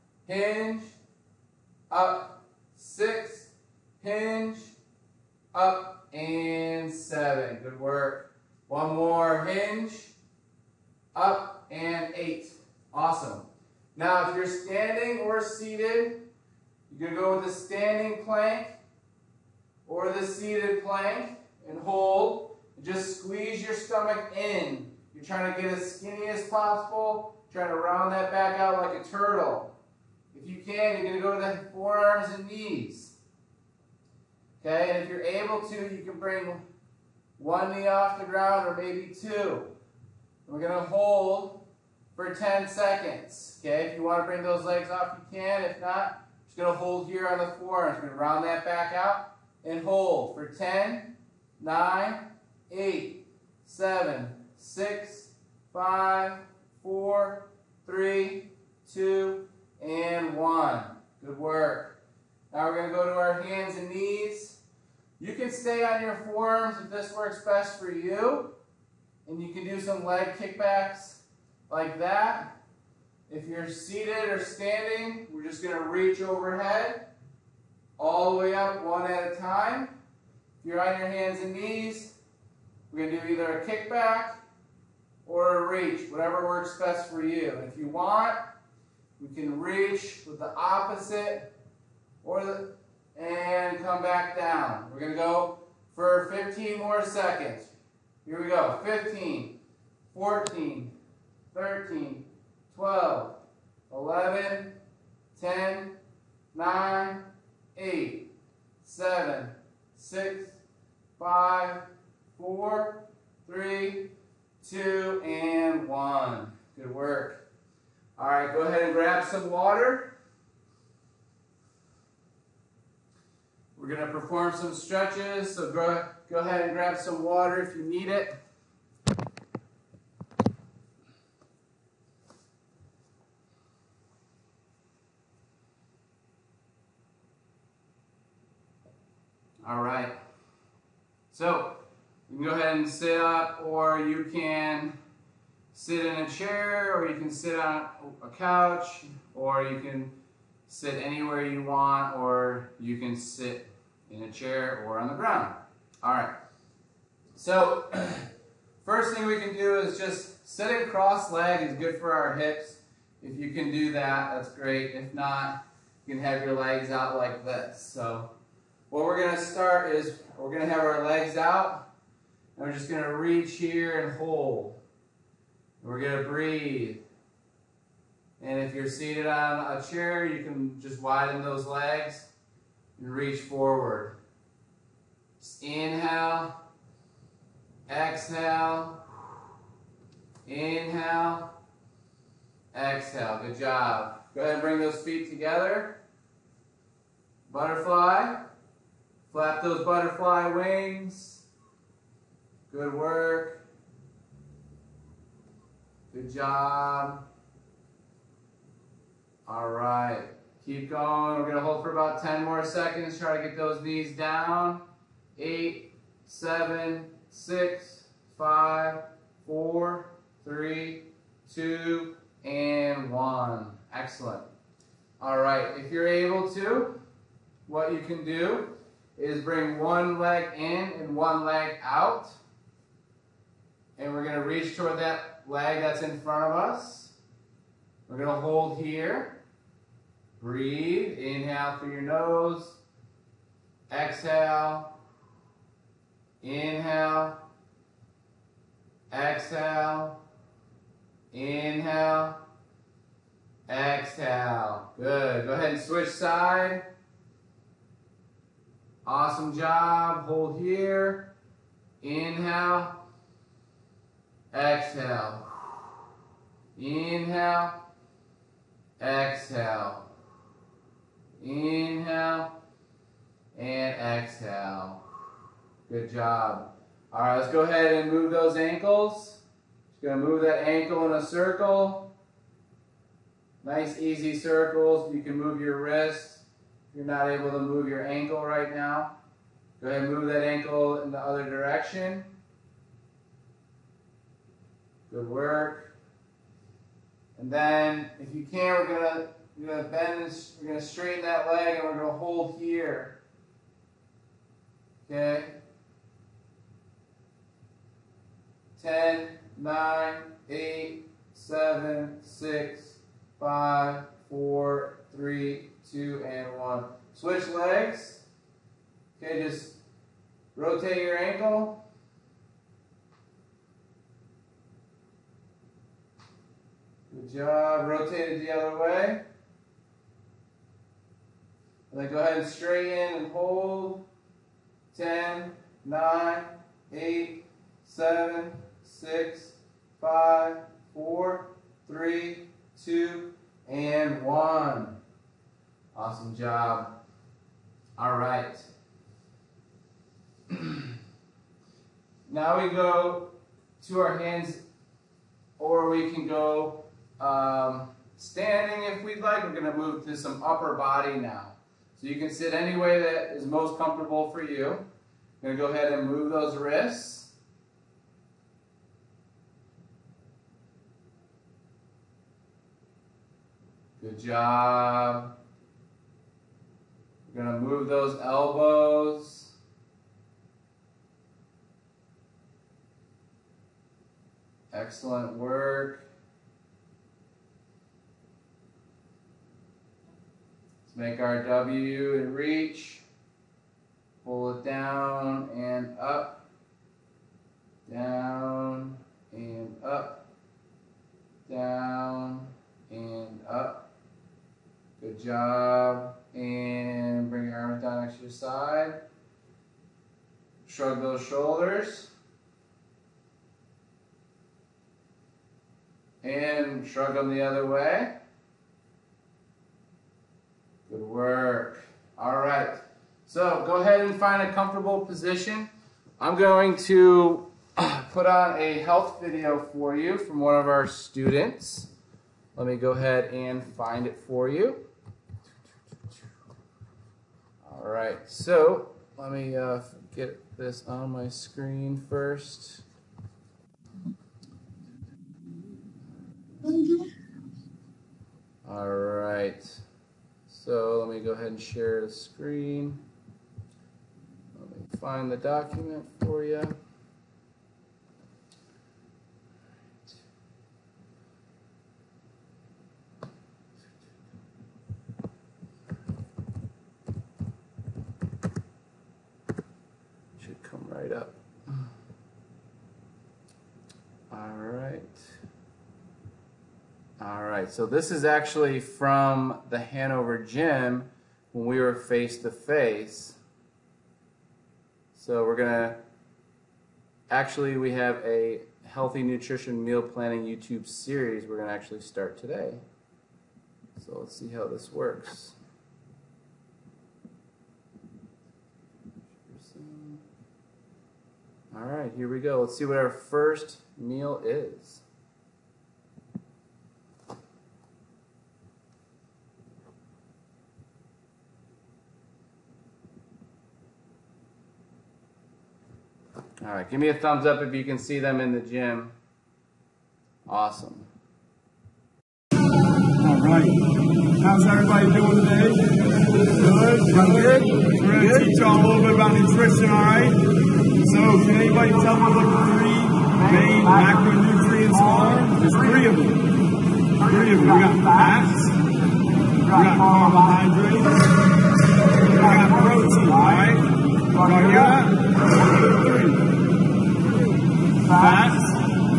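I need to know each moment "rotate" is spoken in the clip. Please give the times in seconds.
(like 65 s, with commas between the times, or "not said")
320 s, 327 s.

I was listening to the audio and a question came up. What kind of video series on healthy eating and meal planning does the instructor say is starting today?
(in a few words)
YouTube series.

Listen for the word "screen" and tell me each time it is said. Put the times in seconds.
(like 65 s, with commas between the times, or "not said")
441 s, 452 s.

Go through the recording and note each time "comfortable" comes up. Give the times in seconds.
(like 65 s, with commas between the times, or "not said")
363 s, 424 s.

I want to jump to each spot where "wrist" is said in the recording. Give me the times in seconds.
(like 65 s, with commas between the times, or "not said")
285 s, 366 s.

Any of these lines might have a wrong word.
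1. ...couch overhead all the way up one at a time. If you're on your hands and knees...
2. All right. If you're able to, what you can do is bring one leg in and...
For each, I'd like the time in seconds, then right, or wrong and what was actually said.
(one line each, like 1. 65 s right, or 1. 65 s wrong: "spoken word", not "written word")
1. 75 s wrong: "reach", not "couch"
2. 225 s right.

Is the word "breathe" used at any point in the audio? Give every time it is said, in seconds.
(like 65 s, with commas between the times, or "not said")
176 s, 240 s.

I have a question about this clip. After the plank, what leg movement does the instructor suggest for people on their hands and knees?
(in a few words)
leg kickbacks.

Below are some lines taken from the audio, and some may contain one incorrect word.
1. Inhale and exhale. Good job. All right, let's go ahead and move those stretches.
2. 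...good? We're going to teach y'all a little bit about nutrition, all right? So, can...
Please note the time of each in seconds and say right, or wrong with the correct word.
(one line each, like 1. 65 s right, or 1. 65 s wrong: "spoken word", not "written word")
1. 271 s wrong: "ankles", not "stretches"
2. 527 s right.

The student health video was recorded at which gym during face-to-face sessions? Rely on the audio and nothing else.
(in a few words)
Hanover gym.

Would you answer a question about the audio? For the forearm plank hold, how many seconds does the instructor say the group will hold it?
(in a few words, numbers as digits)
10 seconds.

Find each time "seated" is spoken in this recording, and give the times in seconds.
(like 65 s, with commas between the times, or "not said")
15 s, 20 s, 73 s, 178 s.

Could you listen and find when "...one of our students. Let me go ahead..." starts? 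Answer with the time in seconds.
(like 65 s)
430 s.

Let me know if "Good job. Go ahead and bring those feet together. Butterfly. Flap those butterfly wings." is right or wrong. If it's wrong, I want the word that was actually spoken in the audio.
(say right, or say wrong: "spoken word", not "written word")
right.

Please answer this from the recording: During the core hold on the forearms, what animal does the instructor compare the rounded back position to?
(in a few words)
turtle.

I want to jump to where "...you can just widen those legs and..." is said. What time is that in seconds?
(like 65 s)
180 s.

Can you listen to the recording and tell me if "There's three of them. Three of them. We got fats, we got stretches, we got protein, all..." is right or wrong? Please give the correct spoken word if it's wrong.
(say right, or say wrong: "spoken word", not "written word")
wrong: "carbohydrates", not "stretches".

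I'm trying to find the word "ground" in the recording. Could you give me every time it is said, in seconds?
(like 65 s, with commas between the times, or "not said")
38 s, 155 s.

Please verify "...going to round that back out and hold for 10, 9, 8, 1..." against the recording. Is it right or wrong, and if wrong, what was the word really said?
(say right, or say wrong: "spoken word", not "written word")
wrong: "7", not "1".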